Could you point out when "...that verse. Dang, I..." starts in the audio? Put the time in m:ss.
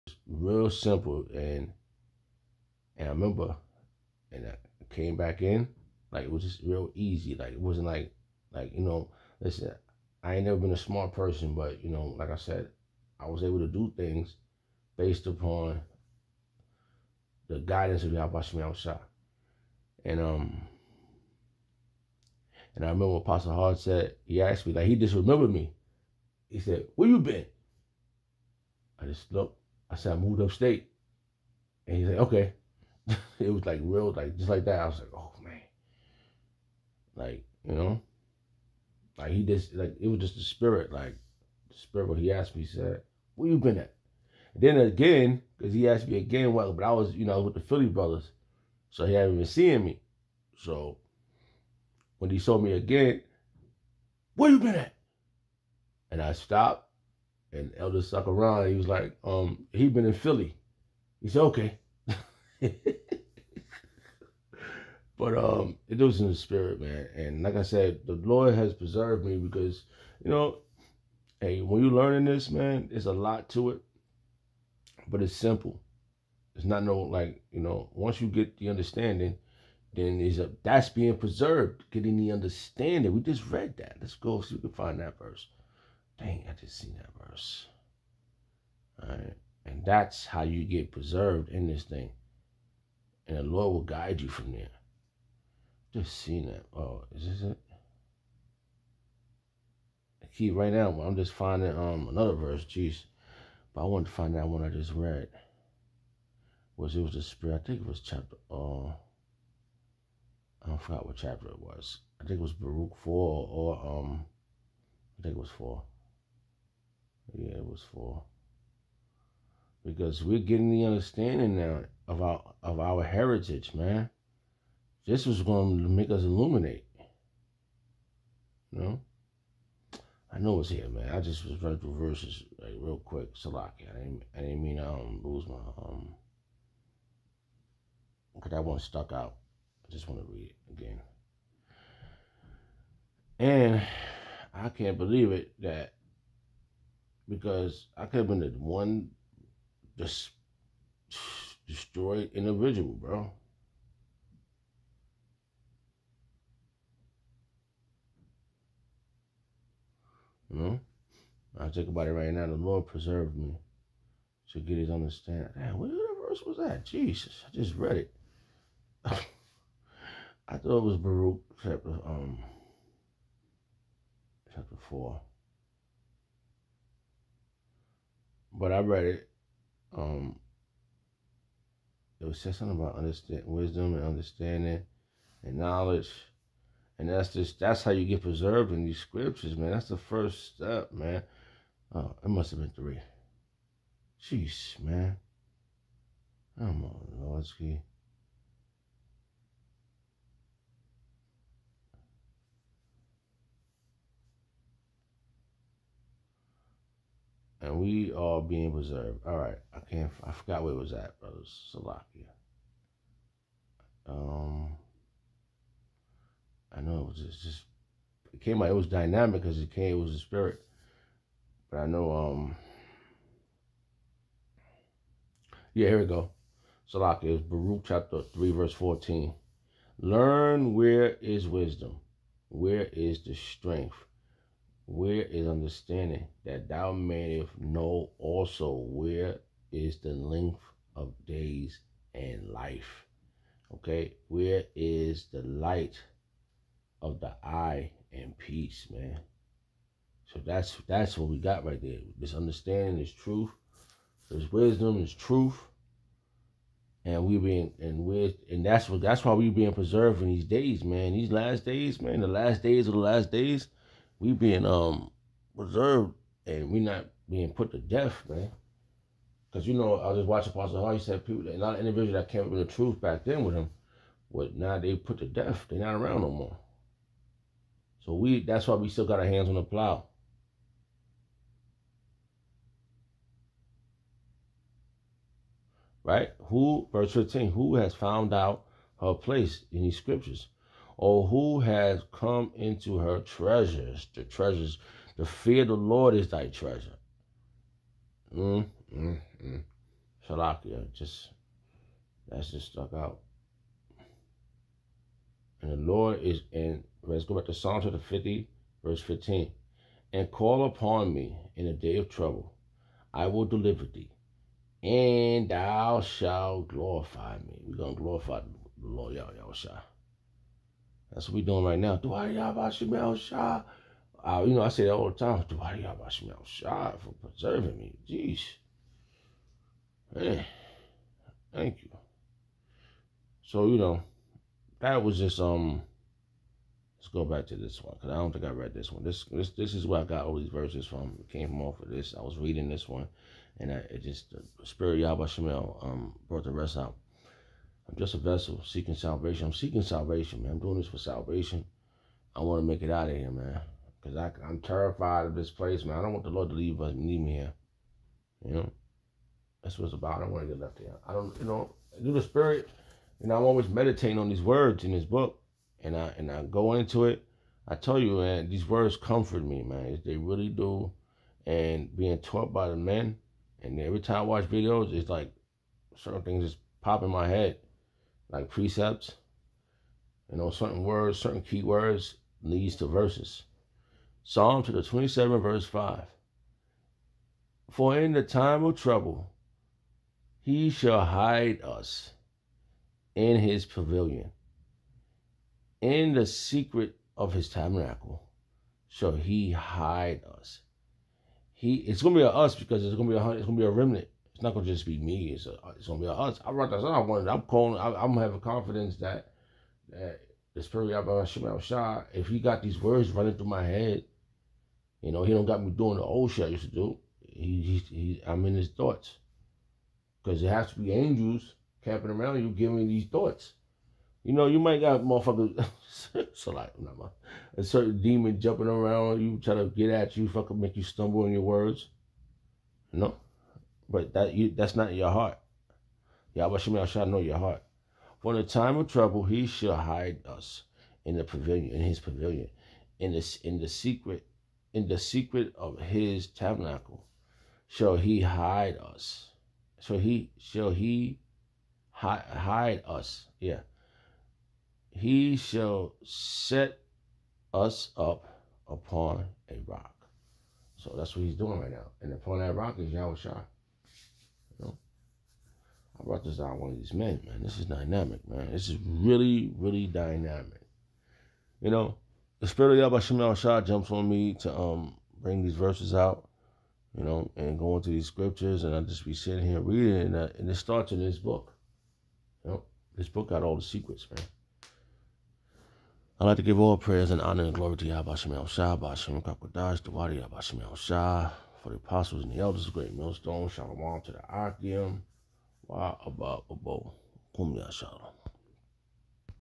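1:24.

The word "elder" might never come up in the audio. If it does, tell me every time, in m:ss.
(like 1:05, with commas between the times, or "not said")
0:57, 8:12.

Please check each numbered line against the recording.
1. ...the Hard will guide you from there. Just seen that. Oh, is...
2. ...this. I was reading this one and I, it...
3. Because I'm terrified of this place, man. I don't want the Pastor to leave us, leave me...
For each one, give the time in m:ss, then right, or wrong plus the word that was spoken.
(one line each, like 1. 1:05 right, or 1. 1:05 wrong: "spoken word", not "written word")
1. 1:33 wrong: "Lord", not "Hard"
2. 5:41 right
3. 5:54 wrong: "Lord", not "Pastor".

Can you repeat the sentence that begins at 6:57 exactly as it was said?
He, he, he I'm in his thoughts, because it has to be angels camping around you, giving these thoughts.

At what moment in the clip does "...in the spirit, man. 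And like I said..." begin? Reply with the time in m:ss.
1:06.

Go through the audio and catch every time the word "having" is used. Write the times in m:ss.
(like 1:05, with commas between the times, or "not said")
6:48.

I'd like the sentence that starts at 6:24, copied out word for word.
Psalm to the 27 verse 5.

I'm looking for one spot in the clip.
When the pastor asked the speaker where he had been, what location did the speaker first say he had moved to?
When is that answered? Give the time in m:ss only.
0:30.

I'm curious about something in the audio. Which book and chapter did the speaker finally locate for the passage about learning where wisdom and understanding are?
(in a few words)
Baruch chapter 3.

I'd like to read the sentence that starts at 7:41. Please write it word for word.
And upon that rock is Yahweh Shai.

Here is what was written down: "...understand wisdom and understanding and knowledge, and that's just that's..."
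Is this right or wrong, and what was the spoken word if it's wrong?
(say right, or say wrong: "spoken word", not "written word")
right.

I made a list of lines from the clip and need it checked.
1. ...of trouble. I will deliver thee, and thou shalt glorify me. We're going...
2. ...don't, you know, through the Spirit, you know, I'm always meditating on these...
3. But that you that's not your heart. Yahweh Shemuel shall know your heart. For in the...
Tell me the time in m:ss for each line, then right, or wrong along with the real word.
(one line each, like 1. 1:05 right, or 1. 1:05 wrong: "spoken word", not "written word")
1. 5:11 right
2. 6:01 right
3. 7:13 right.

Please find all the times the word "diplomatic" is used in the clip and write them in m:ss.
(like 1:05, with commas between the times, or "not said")
not said.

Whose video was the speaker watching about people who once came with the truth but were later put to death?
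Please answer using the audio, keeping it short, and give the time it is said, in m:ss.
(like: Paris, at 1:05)
Apostle Hall, at 4:30.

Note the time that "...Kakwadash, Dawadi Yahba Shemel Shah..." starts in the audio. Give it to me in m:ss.
8:09.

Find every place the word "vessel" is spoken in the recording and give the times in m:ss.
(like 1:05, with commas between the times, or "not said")
5:48.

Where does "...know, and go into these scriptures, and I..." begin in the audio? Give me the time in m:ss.
7:57.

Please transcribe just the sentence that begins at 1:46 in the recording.
Was it was the spirit, I think it was chapter uh I forgot what chapter it was.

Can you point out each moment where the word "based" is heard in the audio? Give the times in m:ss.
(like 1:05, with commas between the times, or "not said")
0:14.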